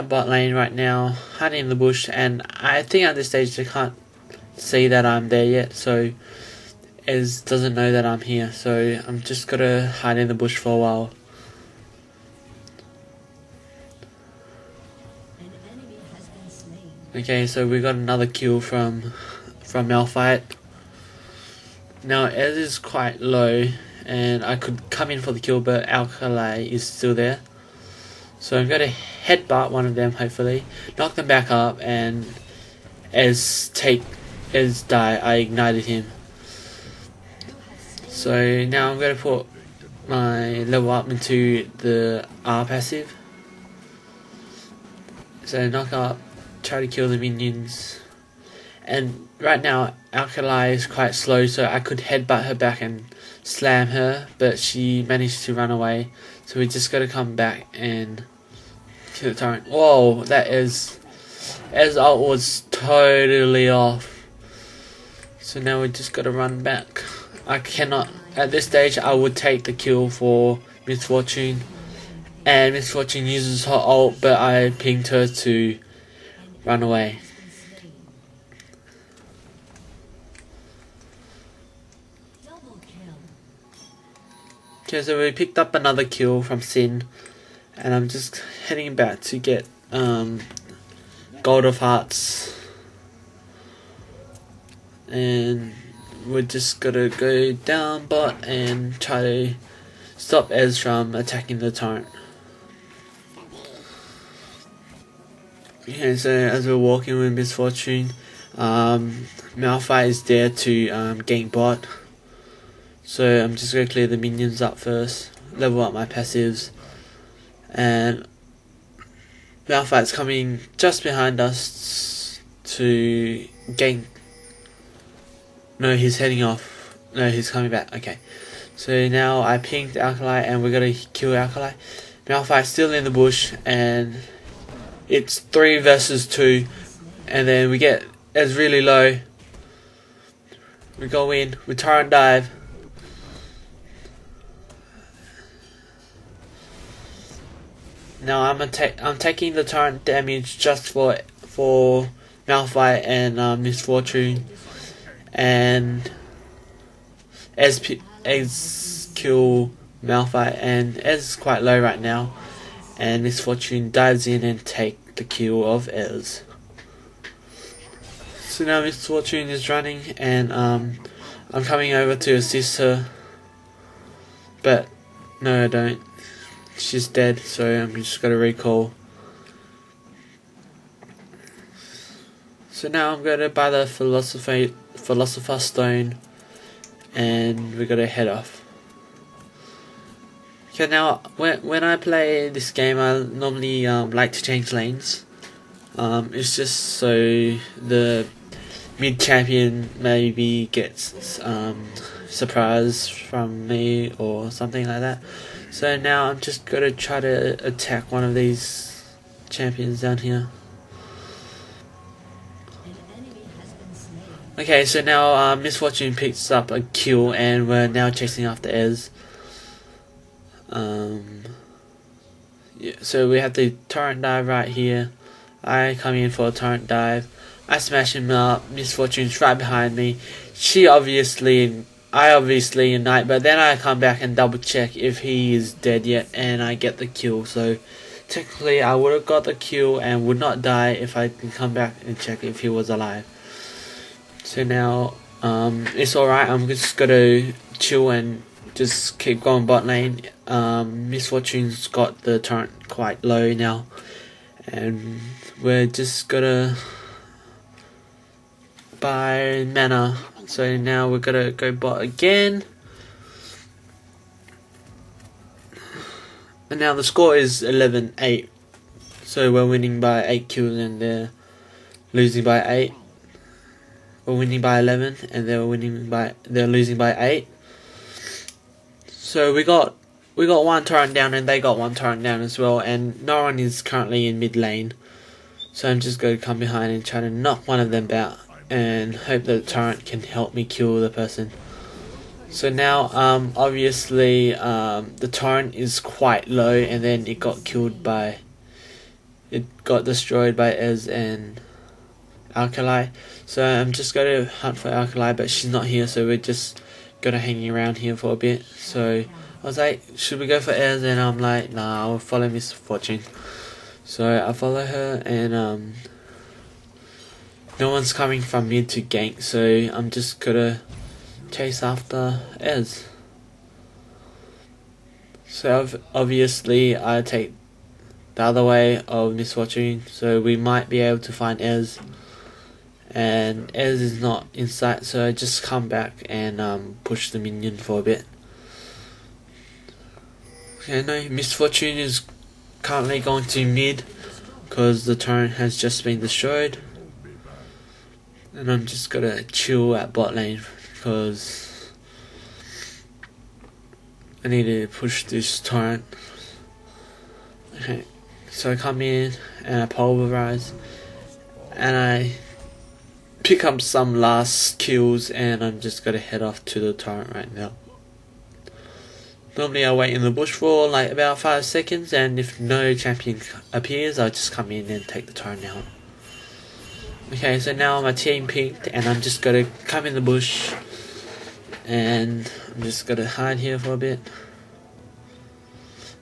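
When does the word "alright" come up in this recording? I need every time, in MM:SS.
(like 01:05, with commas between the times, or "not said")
04:06.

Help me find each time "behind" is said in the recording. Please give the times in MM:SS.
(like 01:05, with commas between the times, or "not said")
02:01, 03:49, 04:46.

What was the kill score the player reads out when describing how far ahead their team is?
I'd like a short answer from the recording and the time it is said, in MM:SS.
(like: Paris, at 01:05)
11 to 8, at 04:27.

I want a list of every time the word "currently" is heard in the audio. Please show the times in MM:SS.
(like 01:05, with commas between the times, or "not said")
04:43, 05:42.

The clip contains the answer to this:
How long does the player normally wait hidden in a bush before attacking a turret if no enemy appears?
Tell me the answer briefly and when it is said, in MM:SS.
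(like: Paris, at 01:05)
5 seconds, at 06:11.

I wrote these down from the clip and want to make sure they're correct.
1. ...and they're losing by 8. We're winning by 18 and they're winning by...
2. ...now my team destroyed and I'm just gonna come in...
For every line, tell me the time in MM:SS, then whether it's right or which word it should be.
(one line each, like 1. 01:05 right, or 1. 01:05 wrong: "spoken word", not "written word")
1. 04:30 wrong: "11", not "18"
2. 06:17 wrong: "peaked", not "destroyed".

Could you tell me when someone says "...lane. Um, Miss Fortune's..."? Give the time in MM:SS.
04:09.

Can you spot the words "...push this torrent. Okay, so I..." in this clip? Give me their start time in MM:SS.
05:54.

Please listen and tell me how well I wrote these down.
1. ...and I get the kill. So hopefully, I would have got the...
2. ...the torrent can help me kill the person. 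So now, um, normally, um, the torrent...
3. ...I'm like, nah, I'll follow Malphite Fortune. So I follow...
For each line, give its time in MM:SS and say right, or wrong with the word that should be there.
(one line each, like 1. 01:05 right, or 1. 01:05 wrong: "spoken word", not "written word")
1. 03:56 wrong: "technically", not "hopefully"
2. 04:49 wrong: "obviously", not "normally"
3. 05:11 wrong: "Miss", not "Malphite".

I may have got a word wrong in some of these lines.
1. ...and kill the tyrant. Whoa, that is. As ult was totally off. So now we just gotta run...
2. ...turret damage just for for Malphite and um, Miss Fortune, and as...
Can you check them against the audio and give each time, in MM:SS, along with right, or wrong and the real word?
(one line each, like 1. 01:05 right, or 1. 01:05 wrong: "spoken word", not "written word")
1. 00:57 right
2. 02:29 right.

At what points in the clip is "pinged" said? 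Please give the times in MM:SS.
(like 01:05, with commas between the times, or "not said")
01:14, 02:09.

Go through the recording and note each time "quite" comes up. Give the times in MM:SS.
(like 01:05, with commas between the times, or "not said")
00:22, 00:50, 02:41, 04:12, 04:55.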